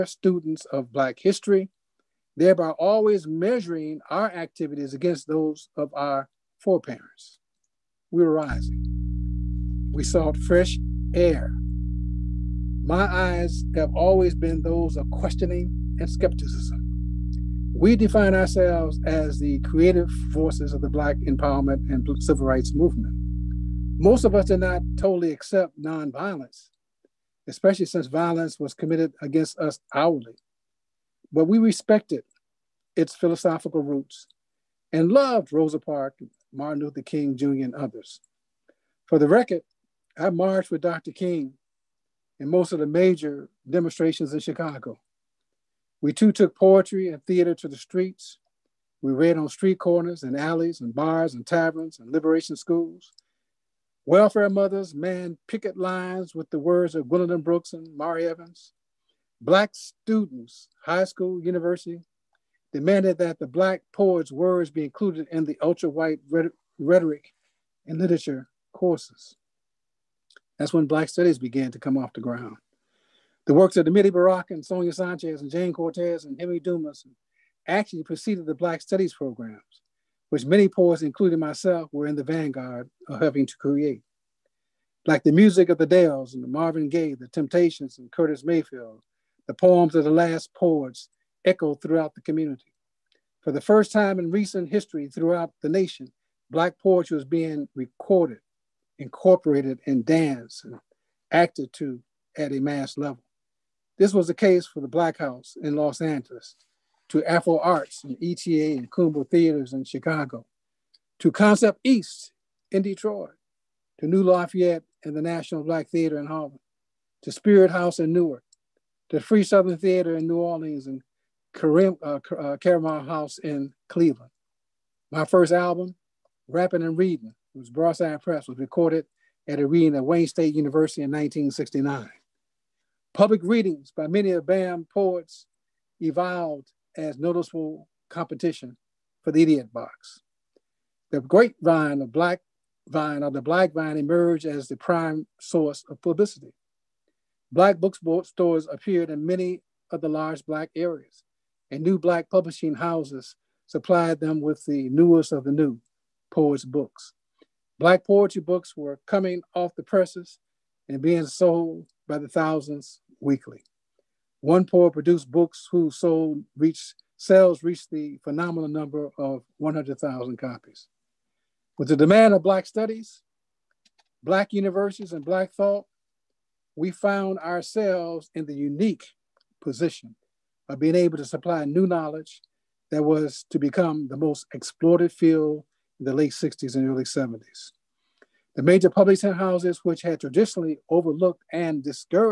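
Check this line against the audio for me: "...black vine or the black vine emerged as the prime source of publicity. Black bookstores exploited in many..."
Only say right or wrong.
wrong.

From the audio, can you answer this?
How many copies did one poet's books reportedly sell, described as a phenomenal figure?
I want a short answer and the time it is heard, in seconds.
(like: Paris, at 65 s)
100,000, at 169 s.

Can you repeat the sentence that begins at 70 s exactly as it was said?
That's when Black Studies began to come off the ground.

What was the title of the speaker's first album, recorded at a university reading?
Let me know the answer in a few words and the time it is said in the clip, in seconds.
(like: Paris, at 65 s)
Rapping and Reading, at 126 s.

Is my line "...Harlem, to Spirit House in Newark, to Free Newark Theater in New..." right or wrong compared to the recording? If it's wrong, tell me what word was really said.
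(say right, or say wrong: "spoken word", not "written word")
wrong: "Southern", not "Newark".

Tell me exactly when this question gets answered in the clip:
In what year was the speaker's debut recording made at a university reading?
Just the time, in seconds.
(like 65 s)
131 s.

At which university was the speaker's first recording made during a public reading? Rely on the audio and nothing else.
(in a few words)
Wayne State University.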